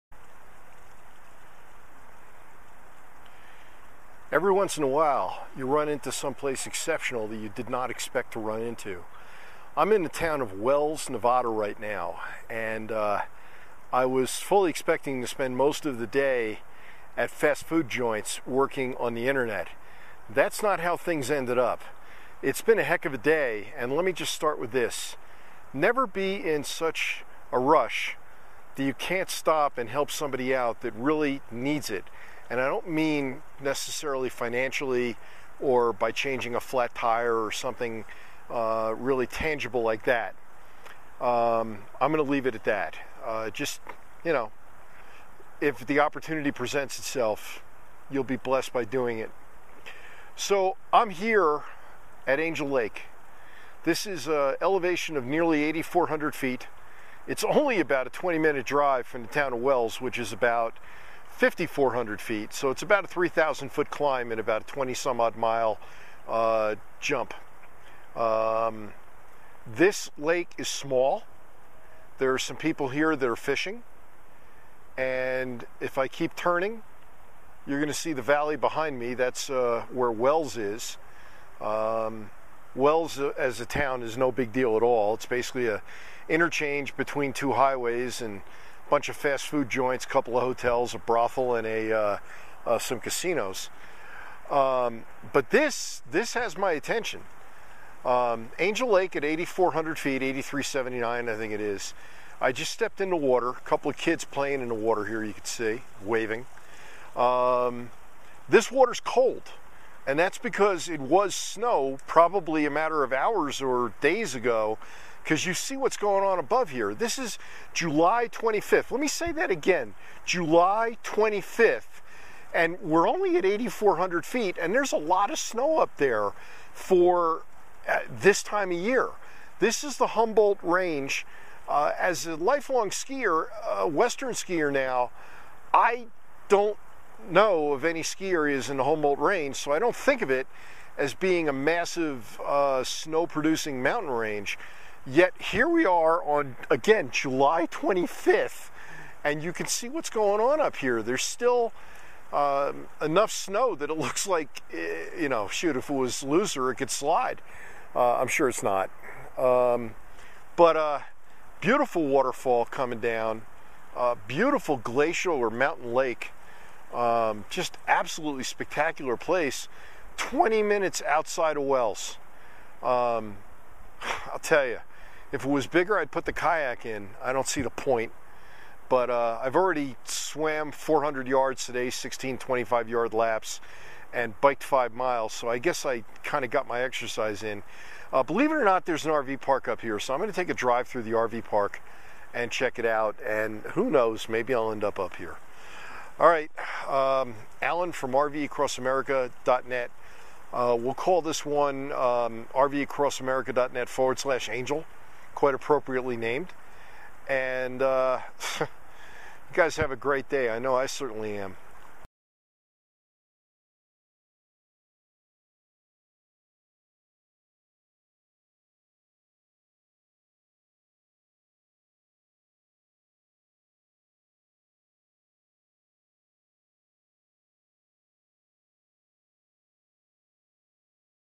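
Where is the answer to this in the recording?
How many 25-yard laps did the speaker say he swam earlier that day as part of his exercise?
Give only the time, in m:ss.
3:01.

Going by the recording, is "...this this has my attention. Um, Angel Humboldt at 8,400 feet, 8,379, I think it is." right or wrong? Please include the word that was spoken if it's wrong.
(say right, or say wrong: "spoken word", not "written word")
wrong: "Lake", not "Humboldt".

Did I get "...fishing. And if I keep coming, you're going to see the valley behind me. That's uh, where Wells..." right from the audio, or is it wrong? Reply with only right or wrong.
wrong.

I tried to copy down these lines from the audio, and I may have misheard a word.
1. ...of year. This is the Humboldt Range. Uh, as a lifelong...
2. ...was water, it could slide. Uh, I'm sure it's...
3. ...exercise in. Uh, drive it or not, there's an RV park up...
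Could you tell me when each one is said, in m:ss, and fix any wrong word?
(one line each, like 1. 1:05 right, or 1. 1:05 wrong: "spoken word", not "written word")
1. 2:08 right
2. 2:35 wrong: "looser", not "water"
3. 3:06 wrong: "believe", not "drive".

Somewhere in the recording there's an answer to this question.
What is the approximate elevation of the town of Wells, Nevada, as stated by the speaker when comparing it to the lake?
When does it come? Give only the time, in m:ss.
1:01.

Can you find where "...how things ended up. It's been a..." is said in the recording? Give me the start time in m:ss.
0:20.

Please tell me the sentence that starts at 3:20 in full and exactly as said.
Uh, we'll call this one um, RVAcrossAmerica.net forward slash angel quite appropriately named.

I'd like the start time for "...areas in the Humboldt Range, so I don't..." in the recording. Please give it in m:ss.
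2:18.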